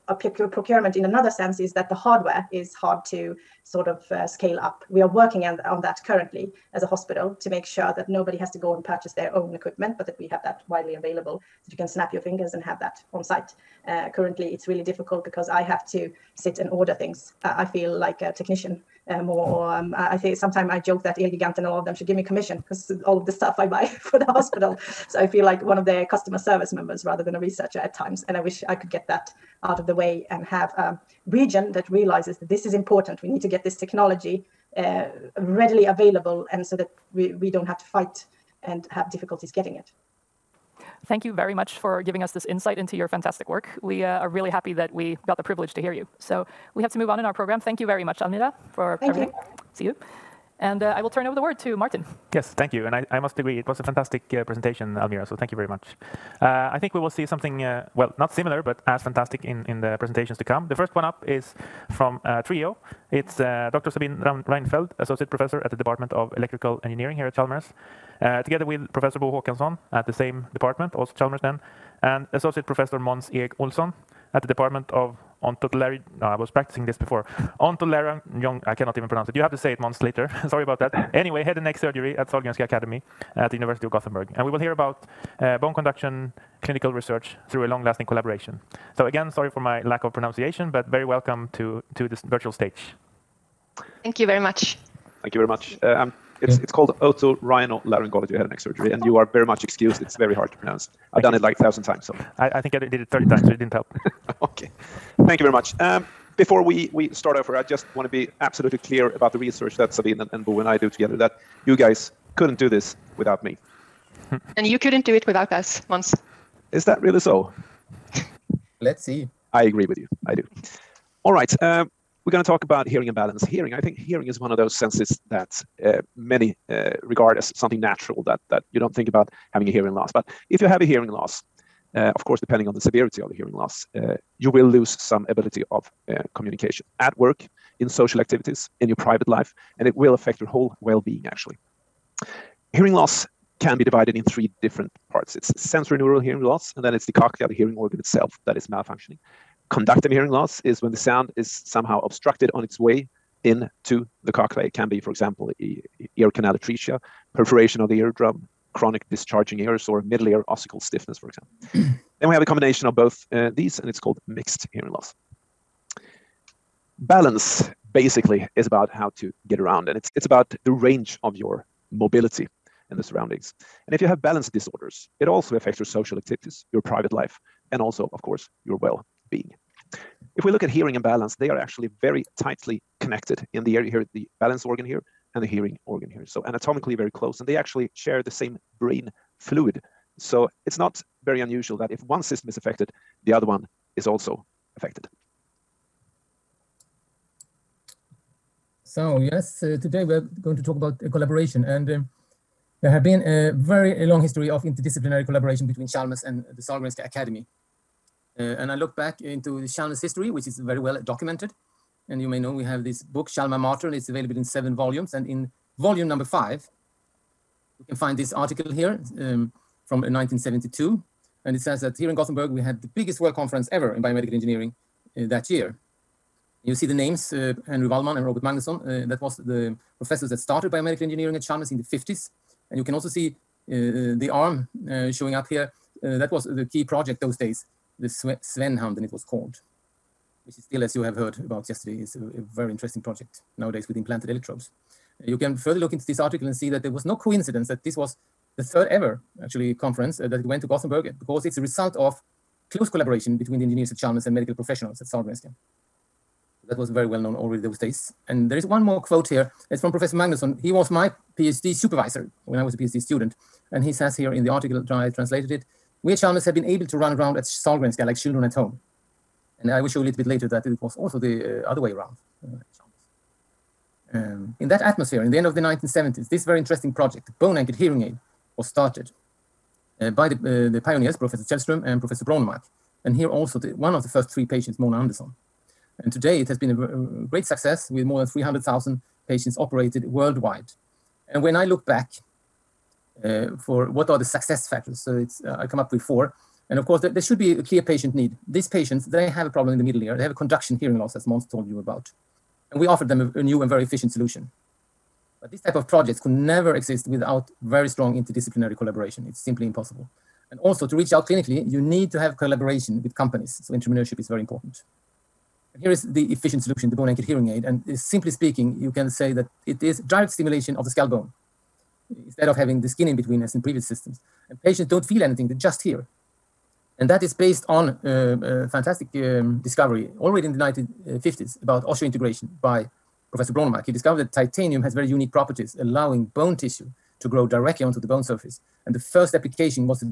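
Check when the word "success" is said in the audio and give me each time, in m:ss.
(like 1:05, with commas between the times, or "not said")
4:47, 4:54.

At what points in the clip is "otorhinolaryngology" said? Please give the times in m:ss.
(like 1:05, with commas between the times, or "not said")
1:36.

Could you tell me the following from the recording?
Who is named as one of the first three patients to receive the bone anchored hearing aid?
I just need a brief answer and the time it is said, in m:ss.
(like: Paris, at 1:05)
Mona Anderson, at 4:44.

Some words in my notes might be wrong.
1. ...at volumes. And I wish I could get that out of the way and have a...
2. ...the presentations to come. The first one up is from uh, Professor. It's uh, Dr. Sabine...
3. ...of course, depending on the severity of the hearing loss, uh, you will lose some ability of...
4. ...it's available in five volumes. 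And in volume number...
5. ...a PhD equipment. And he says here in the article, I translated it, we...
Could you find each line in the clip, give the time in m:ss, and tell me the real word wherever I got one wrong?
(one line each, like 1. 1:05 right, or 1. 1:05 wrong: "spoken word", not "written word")
1. 0:27 wrong: "times", not "volumes"
2. 0:59 wrong: "Trio", not "Professor"
3. 2:12 right
4. 3:33 wrong: "seven", not "five"
5. 4:22 wrong: "student", not "equipment".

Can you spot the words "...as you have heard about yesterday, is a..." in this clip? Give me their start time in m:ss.
4:00.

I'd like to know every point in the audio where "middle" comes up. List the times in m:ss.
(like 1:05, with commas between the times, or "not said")
2:40, 4:59.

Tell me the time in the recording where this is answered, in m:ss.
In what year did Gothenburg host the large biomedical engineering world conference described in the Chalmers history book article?
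3:40.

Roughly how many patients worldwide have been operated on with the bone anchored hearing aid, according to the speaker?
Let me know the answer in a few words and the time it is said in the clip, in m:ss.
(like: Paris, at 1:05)
300,000, at 4:48.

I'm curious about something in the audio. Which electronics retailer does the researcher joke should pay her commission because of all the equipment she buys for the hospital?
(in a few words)
Elgigant.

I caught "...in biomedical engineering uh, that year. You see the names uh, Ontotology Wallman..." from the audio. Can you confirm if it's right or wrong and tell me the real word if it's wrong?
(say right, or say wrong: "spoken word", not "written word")
wrong: "Henry", not "Ontotology".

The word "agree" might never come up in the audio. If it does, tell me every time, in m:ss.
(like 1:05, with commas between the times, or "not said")
0:53, 1:59.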